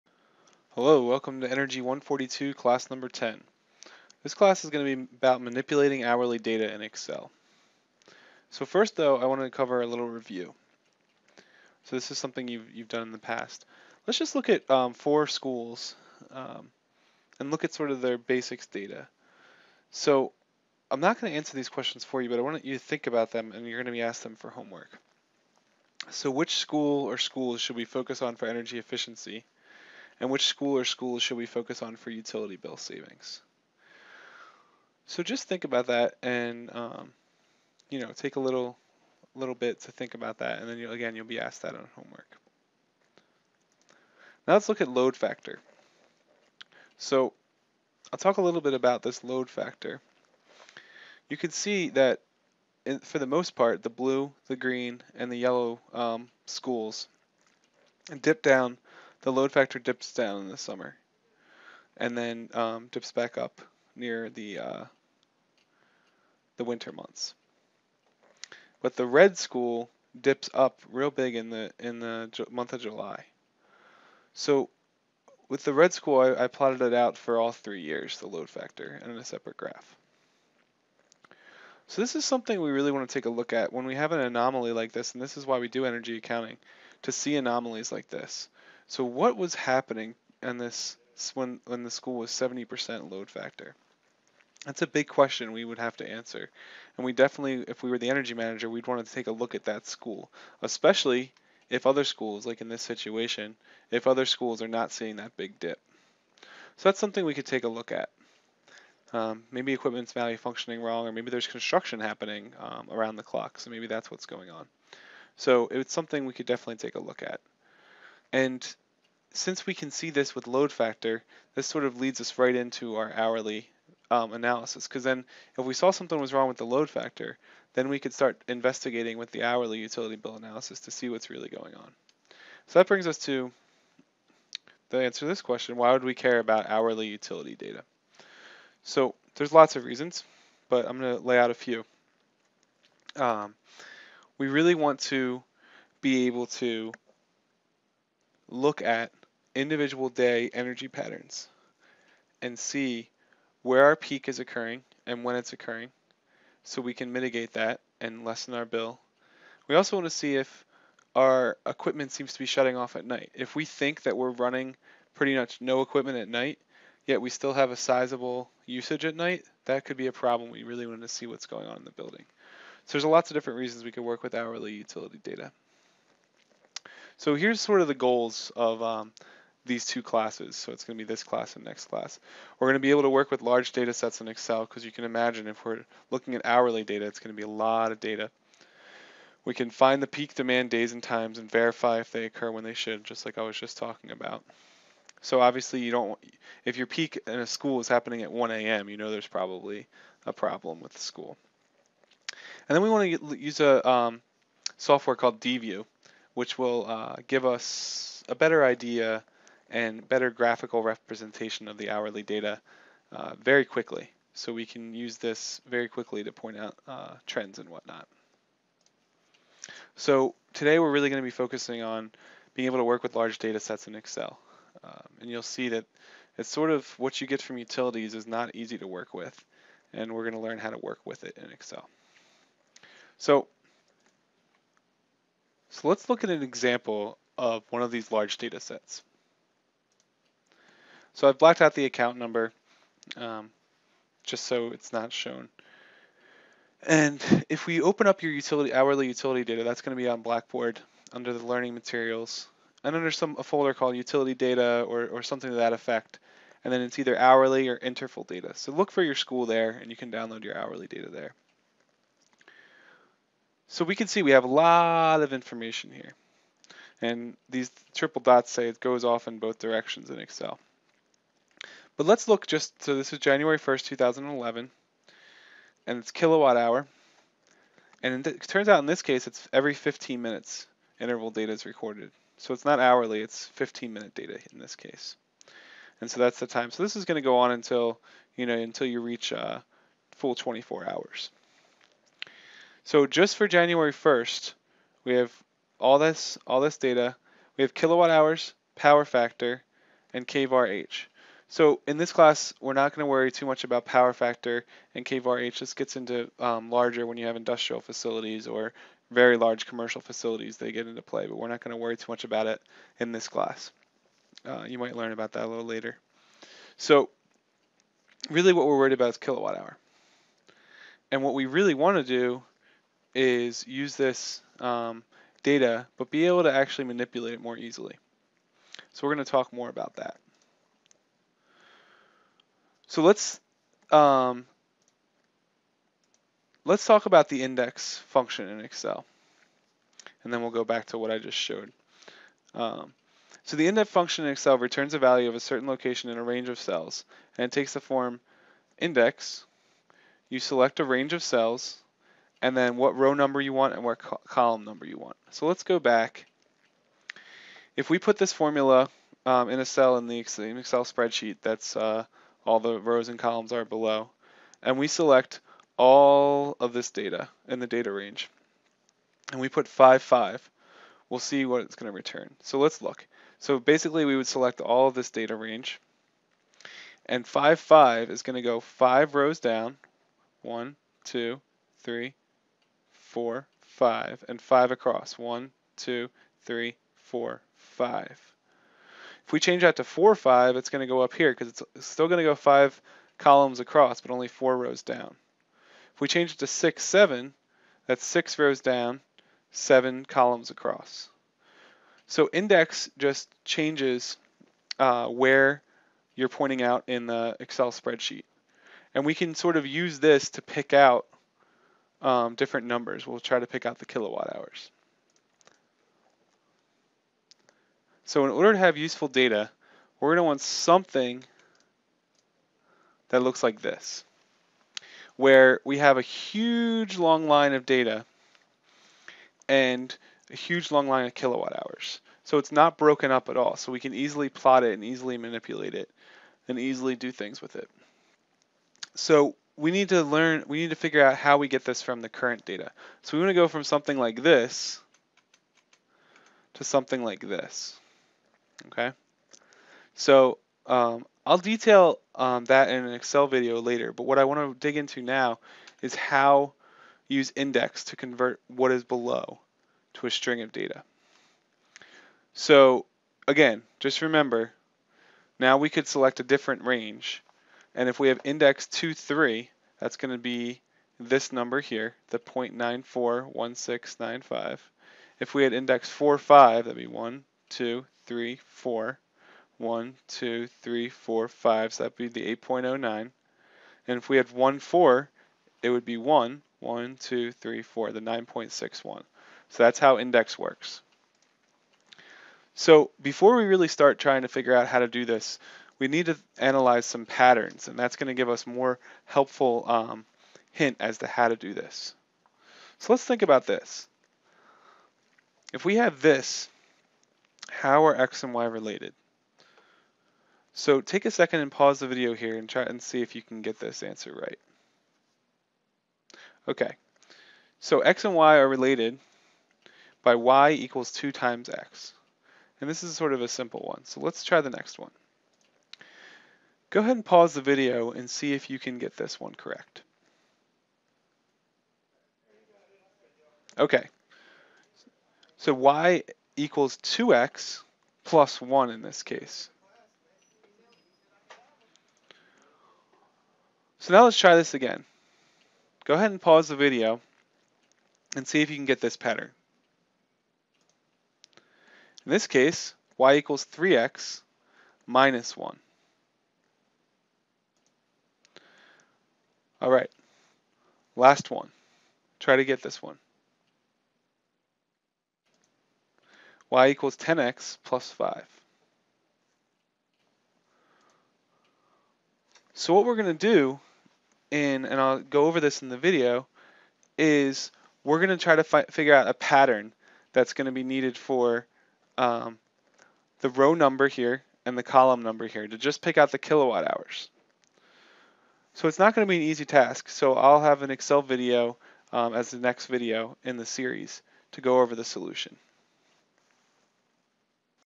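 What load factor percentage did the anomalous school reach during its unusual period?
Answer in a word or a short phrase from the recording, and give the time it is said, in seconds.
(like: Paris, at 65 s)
70%, at 92 s.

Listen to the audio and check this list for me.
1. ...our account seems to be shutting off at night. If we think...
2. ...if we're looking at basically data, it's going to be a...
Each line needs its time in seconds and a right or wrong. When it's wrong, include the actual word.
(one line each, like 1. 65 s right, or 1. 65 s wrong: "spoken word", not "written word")
1. 161 s wrong: "equipment", not "account"
2. 185 s wrong: "hourly", not "basically".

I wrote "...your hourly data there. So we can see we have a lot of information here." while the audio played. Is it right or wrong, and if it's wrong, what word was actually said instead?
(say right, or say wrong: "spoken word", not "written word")
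right.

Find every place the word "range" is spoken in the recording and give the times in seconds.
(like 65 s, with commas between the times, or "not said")
346 s, 350 s, 367 s, 375 s, 466 s.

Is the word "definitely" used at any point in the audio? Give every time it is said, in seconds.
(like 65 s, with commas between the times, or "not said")
97 s, 116 s.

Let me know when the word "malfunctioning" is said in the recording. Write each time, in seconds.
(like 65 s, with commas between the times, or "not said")
110 s.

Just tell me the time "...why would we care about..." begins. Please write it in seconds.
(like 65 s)
135 s.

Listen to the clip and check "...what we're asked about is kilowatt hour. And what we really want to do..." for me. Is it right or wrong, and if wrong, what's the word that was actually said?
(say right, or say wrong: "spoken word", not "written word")
wrong: "worried", not "asked".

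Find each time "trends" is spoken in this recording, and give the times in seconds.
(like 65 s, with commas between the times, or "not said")
217 s.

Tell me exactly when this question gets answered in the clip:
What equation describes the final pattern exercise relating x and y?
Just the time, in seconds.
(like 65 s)
566 s.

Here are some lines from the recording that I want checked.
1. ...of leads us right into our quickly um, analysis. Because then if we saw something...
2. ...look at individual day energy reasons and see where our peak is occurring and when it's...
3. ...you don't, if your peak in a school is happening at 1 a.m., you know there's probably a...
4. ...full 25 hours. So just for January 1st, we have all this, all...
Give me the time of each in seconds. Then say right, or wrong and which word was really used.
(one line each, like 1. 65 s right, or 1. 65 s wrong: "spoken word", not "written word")
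1. 121 s wrong: "hourly", not "quickly"
2. 148 s wrong: "patterns", not "reasons"
3. 195 s right
4. 290 s wrong: "24", not "25".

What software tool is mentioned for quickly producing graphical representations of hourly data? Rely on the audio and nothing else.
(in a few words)
DView.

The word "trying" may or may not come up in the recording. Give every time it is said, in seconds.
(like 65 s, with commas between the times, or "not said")
493 s.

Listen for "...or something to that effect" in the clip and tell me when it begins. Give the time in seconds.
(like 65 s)
255 s.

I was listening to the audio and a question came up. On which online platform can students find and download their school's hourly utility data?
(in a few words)
Blackboard.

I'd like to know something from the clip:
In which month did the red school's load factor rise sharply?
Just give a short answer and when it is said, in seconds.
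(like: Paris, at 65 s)
July, at 72 s.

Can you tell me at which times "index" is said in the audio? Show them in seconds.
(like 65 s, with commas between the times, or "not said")
337 s, 343 s, 348 s, 402 s, 457 s, 468 s, 475 s, 489 s.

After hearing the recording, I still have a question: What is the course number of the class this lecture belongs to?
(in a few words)
Energy 142.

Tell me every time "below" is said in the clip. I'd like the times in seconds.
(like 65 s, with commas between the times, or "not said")
363 s, 458 s.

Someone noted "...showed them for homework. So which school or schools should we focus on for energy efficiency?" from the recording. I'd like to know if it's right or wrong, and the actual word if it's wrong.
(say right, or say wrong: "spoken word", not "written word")
wrong: "asked", not "showed".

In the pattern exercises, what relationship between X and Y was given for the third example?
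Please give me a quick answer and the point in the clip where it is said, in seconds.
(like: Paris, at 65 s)
y = 3x - 1, at 552 s.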